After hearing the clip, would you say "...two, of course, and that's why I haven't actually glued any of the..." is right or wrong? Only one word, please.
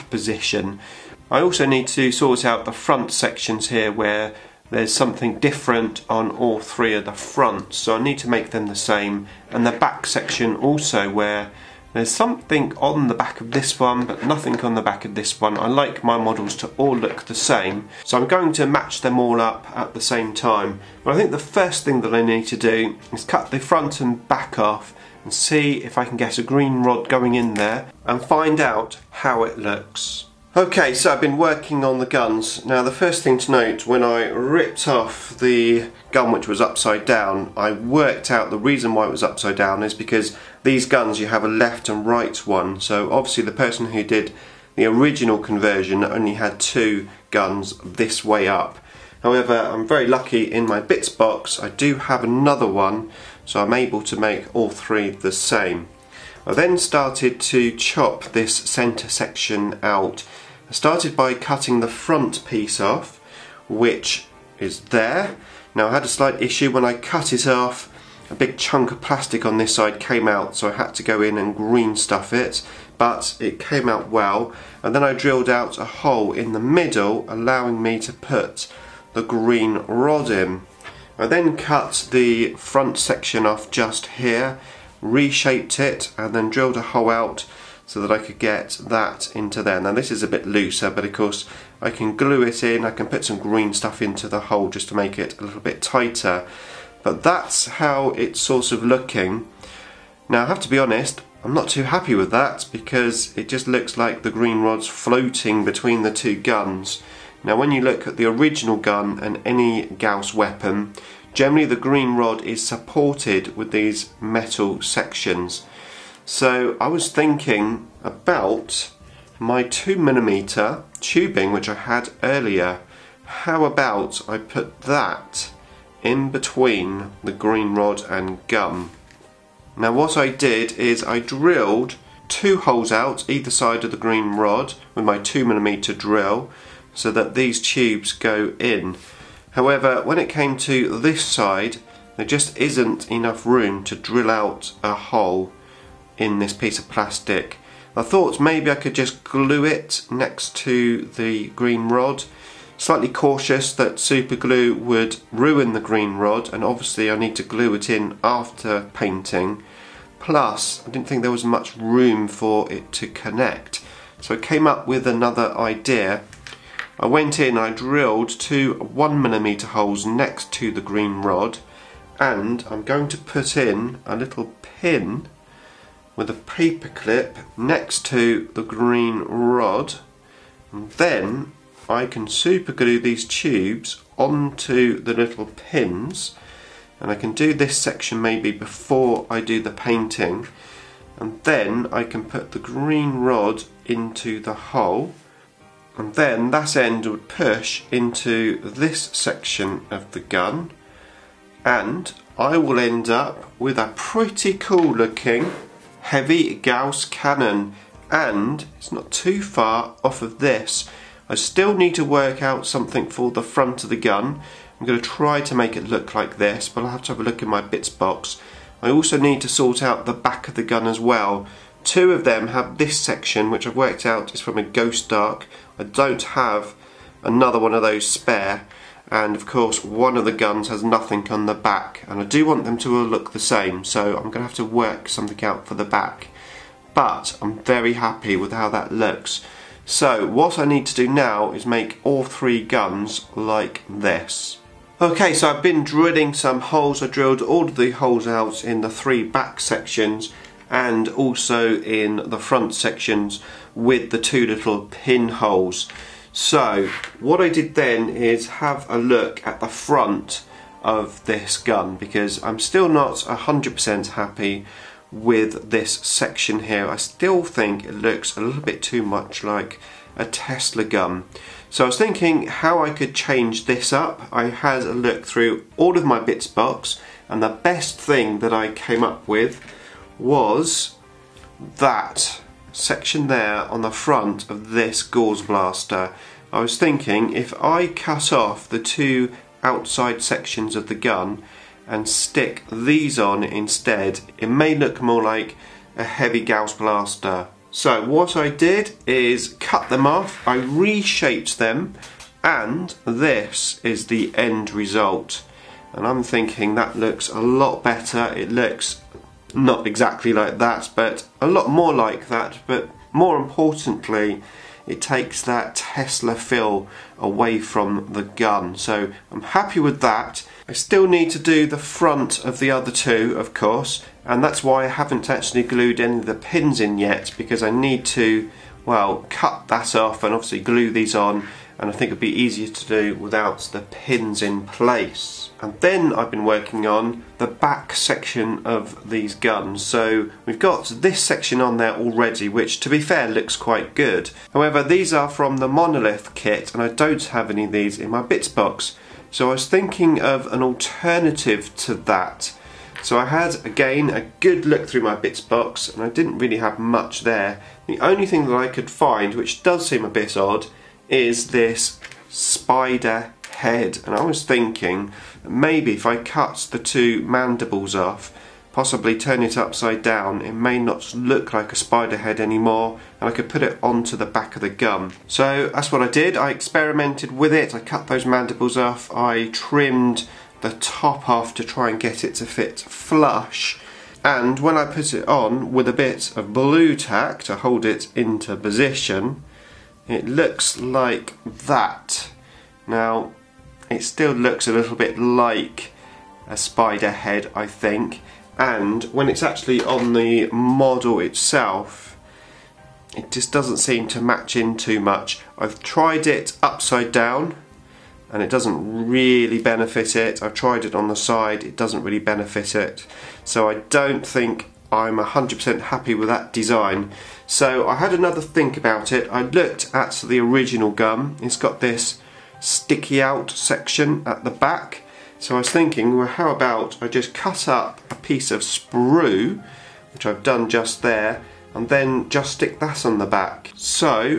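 right.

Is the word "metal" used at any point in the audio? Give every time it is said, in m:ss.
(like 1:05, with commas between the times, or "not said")
1:54.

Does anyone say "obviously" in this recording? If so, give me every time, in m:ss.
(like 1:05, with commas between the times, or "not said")
0:43, 2:36, 5:30.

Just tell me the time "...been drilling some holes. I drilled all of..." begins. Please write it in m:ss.
4:05.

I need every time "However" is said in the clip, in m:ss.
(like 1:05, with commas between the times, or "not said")
0:49, 2:19, 5:44.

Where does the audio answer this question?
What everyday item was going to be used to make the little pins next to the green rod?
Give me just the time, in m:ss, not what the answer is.
2:56.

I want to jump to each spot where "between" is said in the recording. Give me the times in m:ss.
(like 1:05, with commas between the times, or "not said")
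1:45, 2:06.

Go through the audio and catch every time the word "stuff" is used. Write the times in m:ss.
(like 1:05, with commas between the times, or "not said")
1:11, 1:33.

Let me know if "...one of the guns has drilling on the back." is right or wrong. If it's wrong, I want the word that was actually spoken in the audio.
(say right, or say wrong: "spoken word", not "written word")
wrong: "nothing", not "drilling".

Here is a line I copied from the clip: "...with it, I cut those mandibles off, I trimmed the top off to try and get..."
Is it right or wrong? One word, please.
right.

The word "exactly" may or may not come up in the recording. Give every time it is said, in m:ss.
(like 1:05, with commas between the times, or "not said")
5:09.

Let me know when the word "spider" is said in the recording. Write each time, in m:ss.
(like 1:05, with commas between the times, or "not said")
6:02, 6:11, 6:36.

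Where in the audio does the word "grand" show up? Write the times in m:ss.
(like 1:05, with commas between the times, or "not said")
not said.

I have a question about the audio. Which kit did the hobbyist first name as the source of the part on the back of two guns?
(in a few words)
Ghost Ark.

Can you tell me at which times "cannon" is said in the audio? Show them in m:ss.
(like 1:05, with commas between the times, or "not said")
3:27.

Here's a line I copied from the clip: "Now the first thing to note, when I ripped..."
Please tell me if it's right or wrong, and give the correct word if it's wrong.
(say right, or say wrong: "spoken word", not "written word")
right.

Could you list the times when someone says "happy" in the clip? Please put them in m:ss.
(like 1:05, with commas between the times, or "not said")
1:41, 3:57, 4:24, 5:19, 6:55.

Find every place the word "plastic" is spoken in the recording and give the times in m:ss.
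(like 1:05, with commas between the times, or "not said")
1:09, 2:26.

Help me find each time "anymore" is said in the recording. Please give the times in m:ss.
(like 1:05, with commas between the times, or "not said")
6:12.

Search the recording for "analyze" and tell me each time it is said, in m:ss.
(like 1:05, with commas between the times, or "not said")
not said.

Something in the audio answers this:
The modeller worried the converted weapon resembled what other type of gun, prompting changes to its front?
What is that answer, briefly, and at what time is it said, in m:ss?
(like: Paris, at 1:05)
Tesla gun, at 4:30.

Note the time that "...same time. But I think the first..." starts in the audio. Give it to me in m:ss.
0:20.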